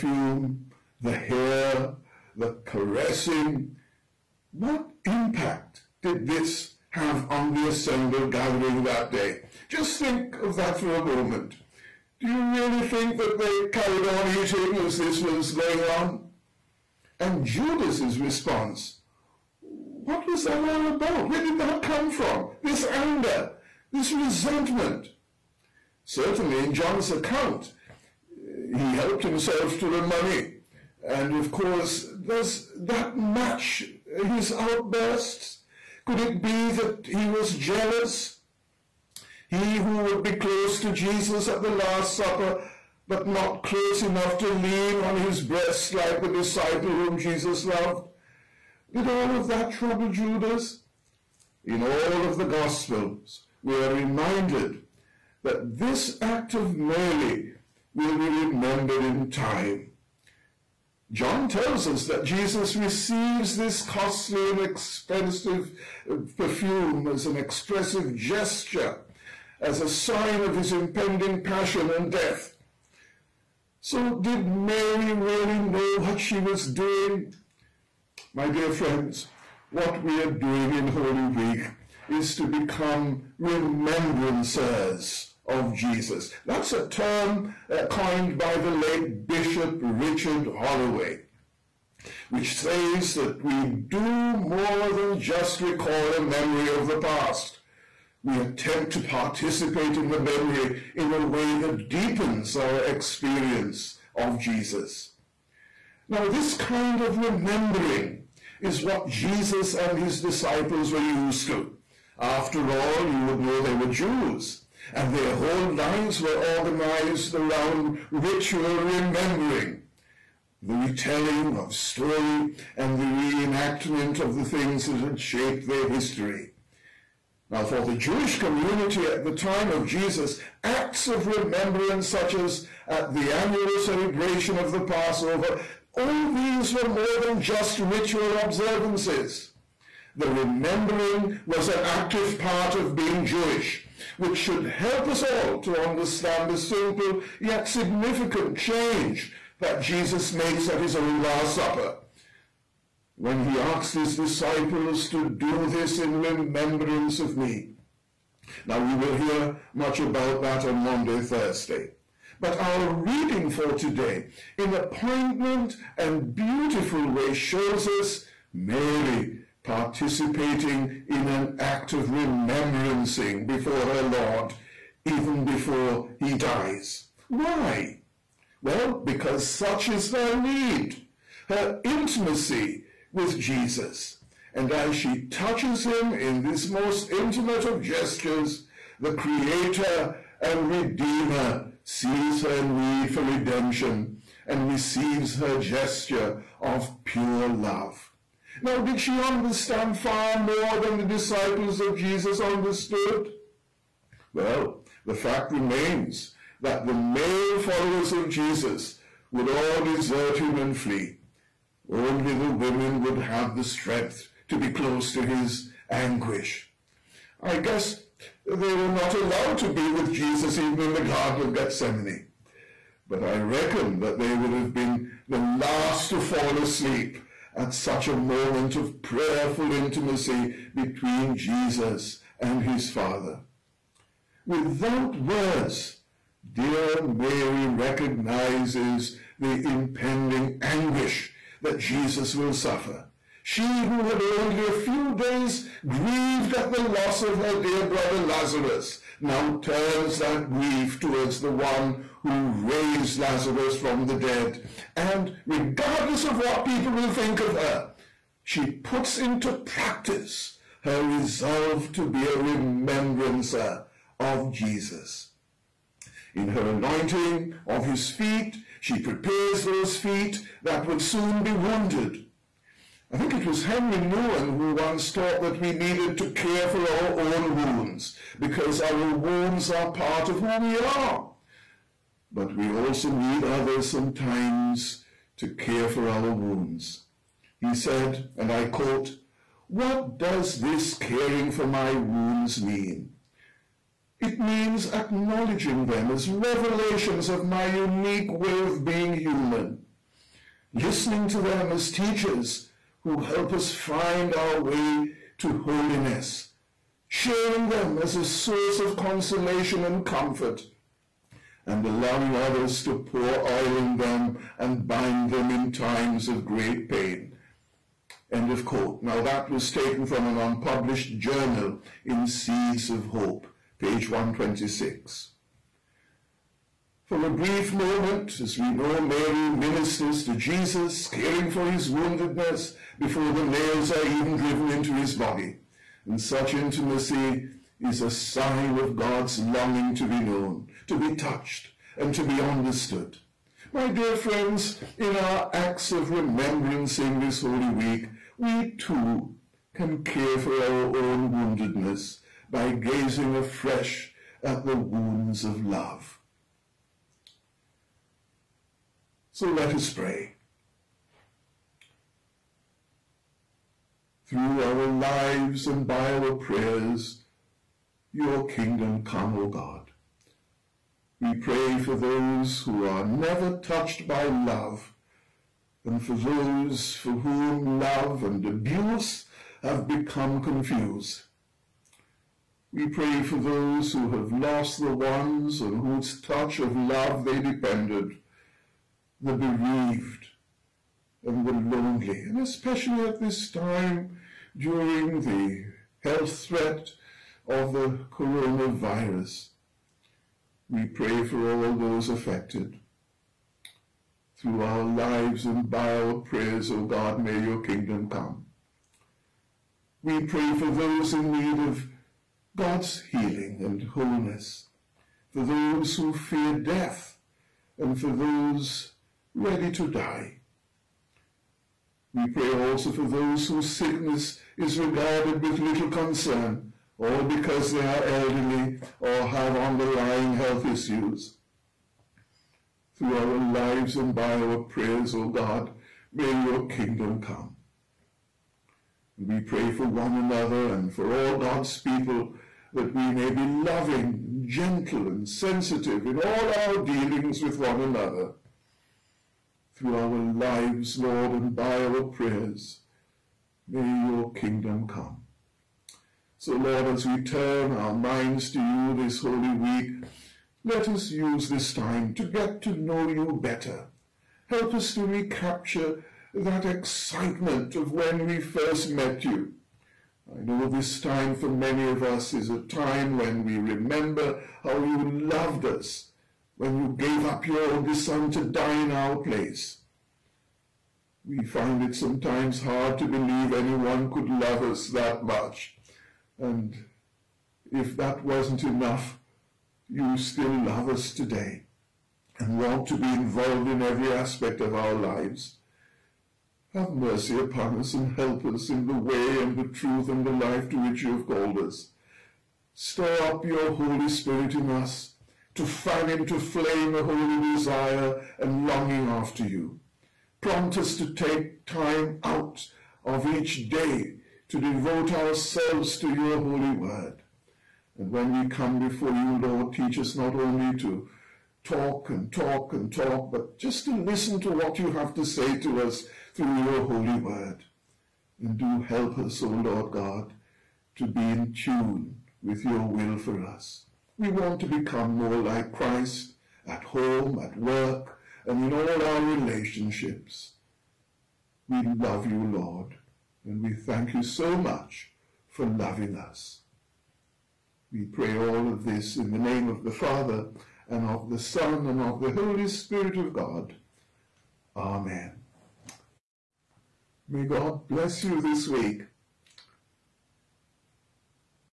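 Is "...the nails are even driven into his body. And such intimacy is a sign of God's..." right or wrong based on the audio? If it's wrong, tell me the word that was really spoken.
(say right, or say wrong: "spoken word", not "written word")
right.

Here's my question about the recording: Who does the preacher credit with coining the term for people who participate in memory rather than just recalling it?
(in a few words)
Richard Holloway.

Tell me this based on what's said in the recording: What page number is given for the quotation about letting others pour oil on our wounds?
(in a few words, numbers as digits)
126.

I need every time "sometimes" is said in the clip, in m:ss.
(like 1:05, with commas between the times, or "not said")
4:43, 8:01.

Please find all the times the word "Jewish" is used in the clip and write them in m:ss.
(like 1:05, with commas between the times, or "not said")
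2:07, 2:23.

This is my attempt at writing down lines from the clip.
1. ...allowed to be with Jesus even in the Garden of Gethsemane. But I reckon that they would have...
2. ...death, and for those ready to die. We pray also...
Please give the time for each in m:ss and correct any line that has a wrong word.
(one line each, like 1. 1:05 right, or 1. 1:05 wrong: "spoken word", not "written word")
1. 3:39 right
2. 6:56 right.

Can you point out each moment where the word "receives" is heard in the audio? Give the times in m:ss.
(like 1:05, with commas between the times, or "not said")
1:02, 3:14.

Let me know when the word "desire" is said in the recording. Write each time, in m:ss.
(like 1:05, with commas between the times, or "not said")
8:27.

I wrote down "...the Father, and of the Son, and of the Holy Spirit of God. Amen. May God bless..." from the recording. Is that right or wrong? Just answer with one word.
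right.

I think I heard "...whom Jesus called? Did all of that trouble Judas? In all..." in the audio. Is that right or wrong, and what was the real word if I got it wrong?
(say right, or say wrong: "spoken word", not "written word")
wrong: "loved", not "called".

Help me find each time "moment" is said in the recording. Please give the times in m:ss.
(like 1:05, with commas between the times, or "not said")
0:11, 3:48, 5:27.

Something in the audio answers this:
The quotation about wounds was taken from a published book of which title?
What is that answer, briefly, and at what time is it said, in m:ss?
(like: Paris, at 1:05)
Seeds of Hope, at 5:22.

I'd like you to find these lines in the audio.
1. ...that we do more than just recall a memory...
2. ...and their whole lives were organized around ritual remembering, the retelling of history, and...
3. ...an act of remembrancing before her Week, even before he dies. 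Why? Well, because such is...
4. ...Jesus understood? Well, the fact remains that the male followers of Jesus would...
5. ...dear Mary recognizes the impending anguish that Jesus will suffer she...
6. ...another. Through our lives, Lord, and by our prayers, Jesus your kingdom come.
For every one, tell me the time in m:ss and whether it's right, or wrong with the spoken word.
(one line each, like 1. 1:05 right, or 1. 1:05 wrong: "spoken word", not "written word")
1. 1:33 right
2. 1:54 wrong: "story", not "history"
3. 2:51 wrong: "Lord", not "Week"
4. 3:21 right
5. 3:56 right
6. 7:27 wrong: "May", not "Jesus".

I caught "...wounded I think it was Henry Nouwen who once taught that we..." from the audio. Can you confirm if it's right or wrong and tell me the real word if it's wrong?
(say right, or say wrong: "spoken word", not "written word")
right.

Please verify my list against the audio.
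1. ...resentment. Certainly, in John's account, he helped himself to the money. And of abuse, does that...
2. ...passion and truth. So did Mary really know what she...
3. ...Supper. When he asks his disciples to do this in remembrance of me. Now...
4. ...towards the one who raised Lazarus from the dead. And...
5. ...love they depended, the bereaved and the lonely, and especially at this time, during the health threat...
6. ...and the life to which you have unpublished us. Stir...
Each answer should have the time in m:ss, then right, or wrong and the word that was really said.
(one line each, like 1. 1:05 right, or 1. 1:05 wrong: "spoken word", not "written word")
1. 0:24 wrong: "course", not "abuse"
2. 1:11 wrong: "death", not "truth"
3. 2:31 right
4. 4:10 right
5. 6:26 right
6. 8:20 wrong: "called", not "unpublished".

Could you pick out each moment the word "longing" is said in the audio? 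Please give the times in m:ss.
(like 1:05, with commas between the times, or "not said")
5:39, 8:28.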